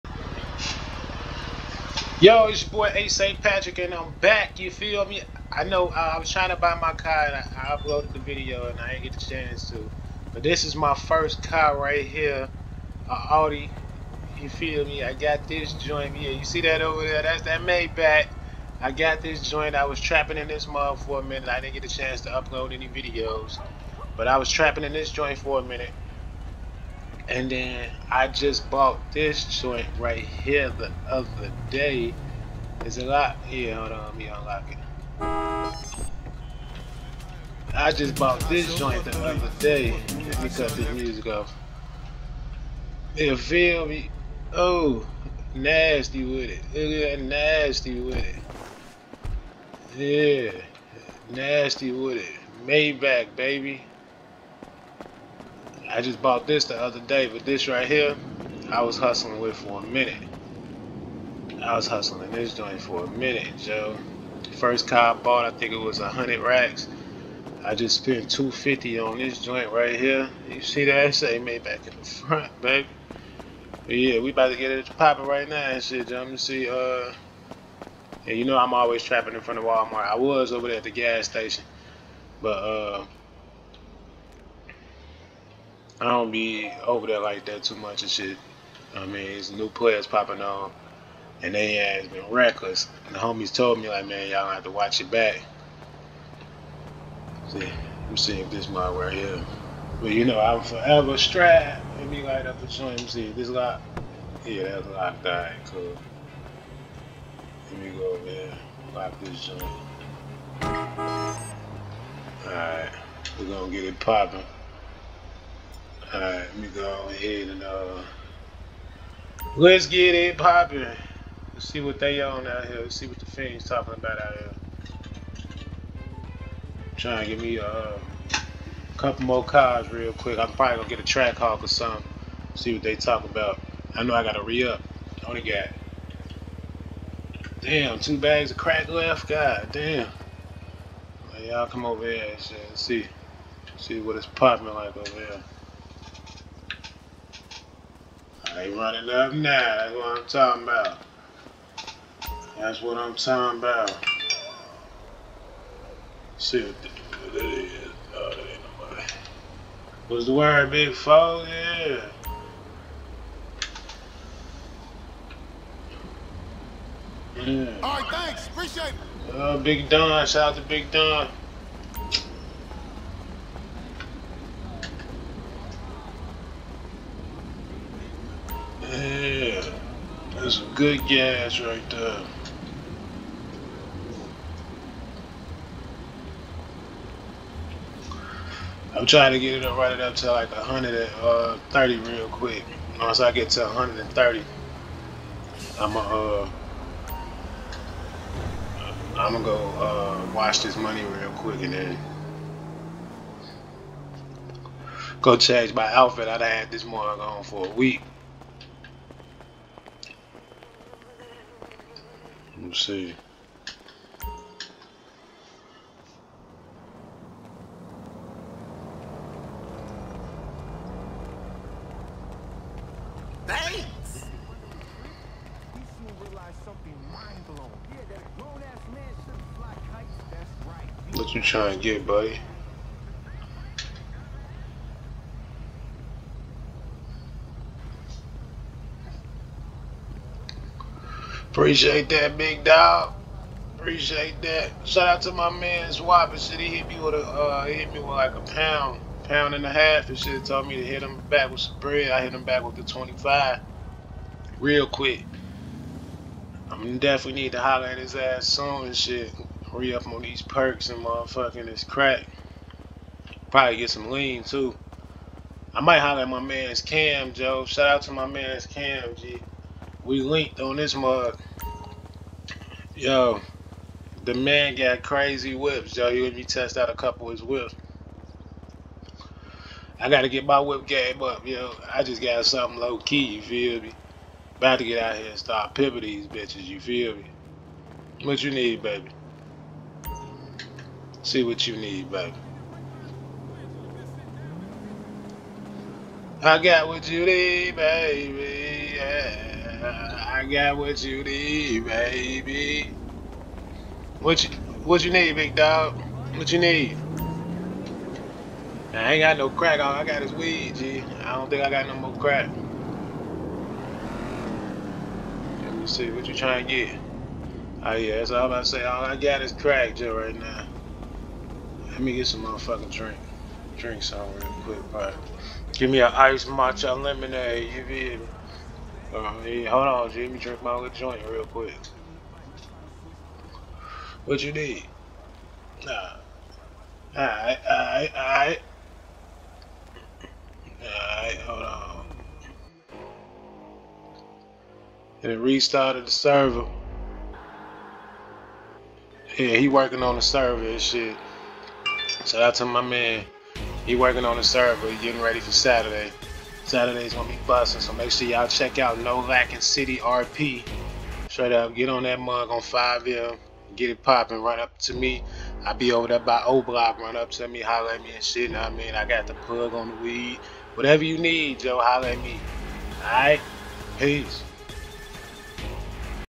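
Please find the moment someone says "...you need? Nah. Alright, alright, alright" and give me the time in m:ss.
5:34.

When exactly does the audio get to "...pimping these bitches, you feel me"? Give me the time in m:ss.
4:45.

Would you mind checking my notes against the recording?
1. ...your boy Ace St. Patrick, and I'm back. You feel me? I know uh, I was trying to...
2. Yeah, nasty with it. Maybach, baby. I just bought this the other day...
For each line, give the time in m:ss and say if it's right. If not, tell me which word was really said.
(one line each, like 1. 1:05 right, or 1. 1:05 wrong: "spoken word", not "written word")
1. 0:02 right
2. 0:50 right.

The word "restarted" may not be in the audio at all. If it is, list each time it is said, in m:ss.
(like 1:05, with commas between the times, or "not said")
5:45.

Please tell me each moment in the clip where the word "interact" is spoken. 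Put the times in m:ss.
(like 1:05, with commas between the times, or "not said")
not said.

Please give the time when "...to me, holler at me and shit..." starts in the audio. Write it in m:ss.
6:07.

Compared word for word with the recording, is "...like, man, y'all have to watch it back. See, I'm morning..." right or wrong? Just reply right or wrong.
wrong.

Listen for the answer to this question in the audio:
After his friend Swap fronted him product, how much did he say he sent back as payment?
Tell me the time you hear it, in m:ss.
4:12.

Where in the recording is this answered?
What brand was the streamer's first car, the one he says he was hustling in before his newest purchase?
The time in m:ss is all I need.
0:13.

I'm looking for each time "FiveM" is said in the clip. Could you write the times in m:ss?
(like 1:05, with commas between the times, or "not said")
6:02.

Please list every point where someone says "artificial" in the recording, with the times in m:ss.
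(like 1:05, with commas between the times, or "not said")
not said.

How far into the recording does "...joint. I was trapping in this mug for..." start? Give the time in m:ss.
0:19.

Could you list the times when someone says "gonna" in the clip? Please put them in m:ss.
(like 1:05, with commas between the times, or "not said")
1:53, 2:10, 3:19, 5:57.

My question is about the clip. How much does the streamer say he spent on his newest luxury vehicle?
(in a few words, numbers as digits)
250.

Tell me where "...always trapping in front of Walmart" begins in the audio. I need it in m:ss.
1:18.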